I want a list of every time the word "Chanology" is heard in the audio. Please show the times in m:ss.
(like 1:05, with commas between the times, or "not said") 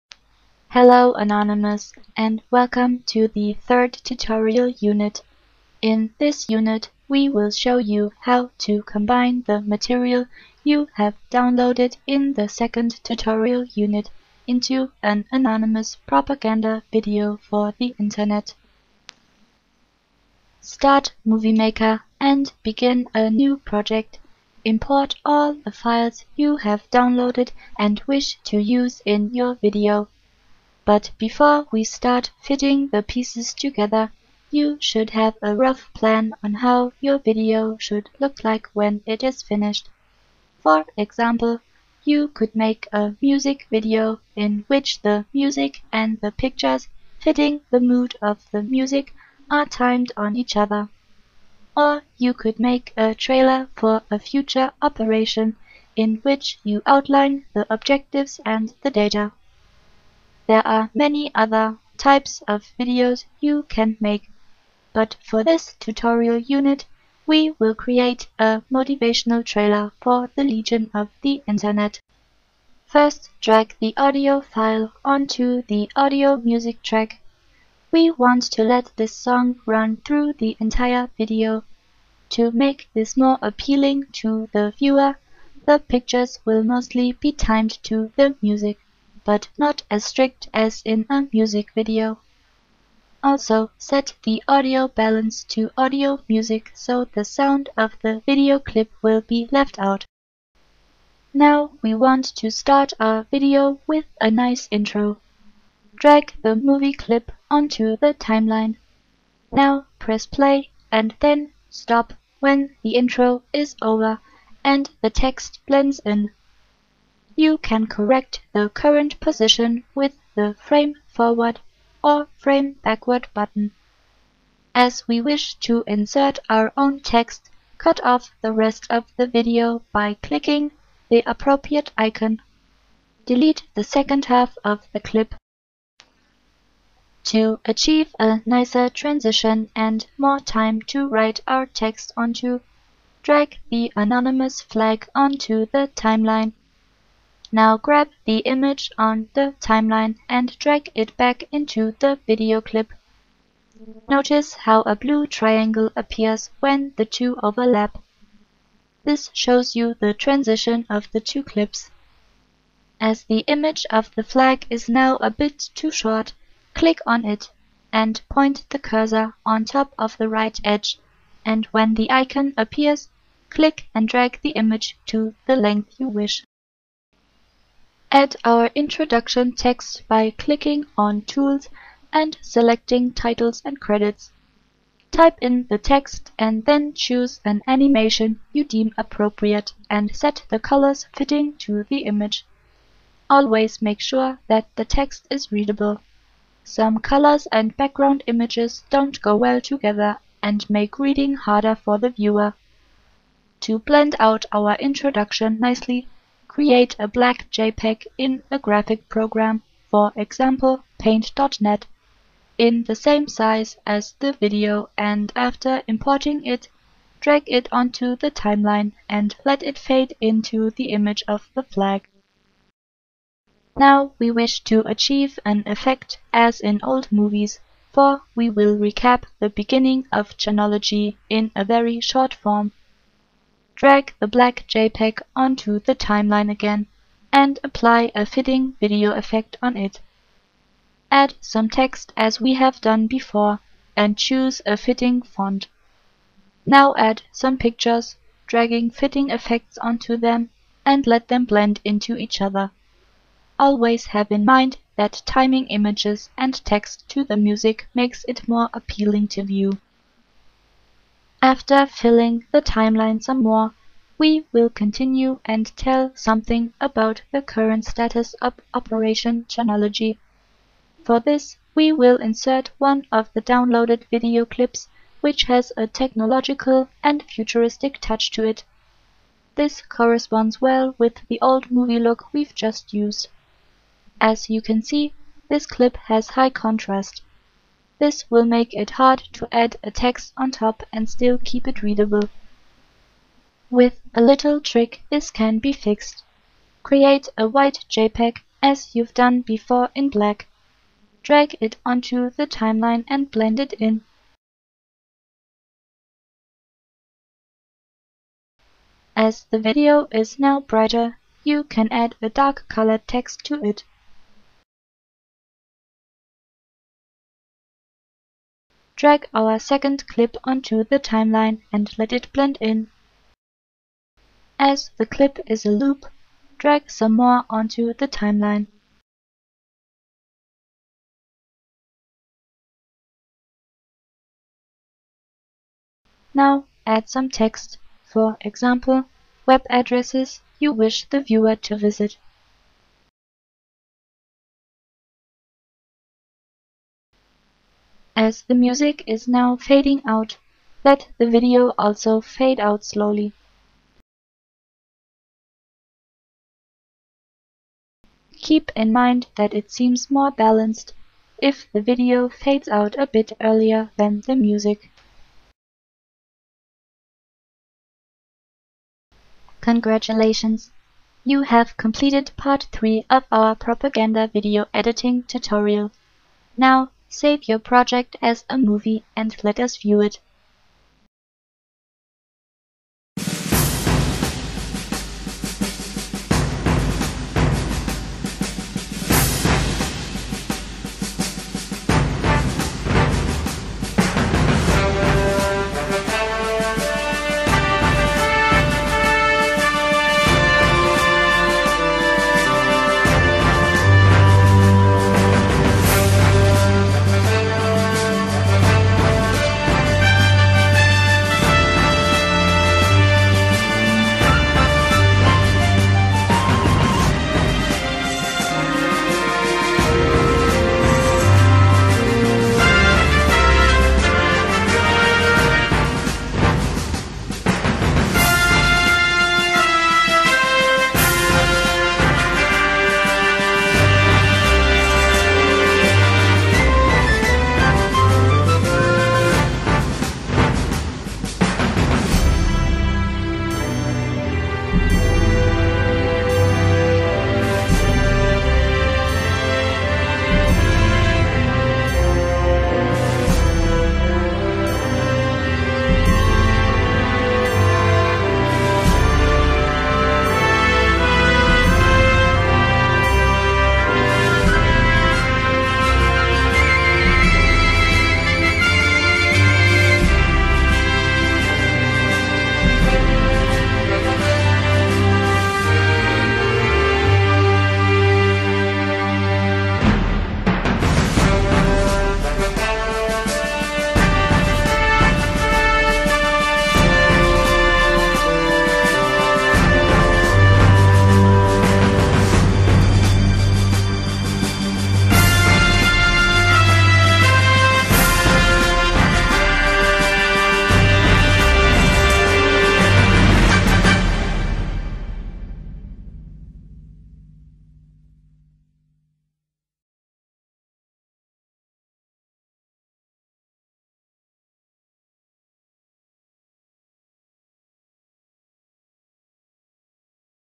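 3:50, 4:29.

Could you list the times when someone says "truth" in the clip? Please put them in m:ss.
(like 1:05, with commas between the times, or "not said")
not said.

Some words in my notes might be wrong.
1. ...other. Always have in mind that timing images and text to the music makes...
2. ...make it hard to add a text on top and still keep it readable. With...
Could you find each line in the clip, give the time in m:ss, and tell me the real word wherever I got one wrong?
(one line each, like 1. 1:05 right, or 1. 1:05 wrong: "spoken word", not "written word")
1. 4:12 right
2. 4:48 right.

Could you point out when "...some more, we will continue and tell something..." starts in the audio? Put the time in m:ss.
4:23.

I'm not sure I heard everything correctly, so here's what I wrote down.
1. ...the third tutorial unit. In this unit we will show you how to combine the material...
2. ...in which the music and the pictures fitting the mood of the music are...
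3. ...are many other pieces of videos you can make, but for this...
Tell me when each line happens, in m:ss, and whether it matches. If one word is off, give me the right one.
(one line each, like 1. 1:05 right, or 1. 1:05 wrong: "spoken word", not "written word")
1. 0:03 right
2. 0:44 right
3. 1:00 wrong: "types", not "pieces".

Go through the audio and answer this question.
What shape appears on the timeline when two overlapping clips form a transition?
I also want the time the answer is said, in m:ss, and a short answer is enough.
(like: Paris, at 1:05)
blue triangle, at 2:34.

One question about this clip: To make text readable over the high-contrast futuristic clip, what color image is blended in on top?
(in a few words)
white.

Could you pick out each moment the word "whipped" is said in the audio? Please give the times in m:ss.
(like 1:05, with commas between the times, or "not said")
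not said.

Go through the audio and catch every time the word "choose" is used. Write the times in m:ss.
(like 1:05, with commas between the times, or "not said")
3:06, 4:04.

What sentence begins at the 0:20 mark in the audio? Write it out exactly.
Start Movie Maker and begin a new project import all the files you have downloaded and wish to use in your video.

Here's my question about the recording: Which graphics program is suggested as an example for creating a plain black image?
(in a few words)
paint.net.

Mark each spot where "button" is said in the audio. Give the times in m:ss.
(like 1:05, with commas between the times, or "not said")
2:03.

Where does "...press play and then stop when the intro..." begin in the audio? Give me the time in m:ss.
1:49.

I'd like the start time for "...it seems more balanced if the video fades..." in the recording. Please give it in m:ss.
5:59.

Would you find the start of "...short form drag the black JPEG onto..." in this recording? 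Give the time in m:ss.
3:52.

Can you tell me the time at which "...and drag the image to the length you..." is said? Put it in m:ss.
2:53.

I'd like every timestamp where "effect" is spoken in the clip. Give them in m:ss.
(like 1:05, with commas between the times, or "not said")
3:45, 3:59, 4:09.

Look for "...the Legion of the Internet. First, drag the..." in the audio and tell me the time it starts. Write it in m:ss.
1:10.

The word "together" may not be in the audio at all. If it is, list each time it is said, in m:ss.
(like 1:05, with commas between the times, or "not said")
0:33, 3:19.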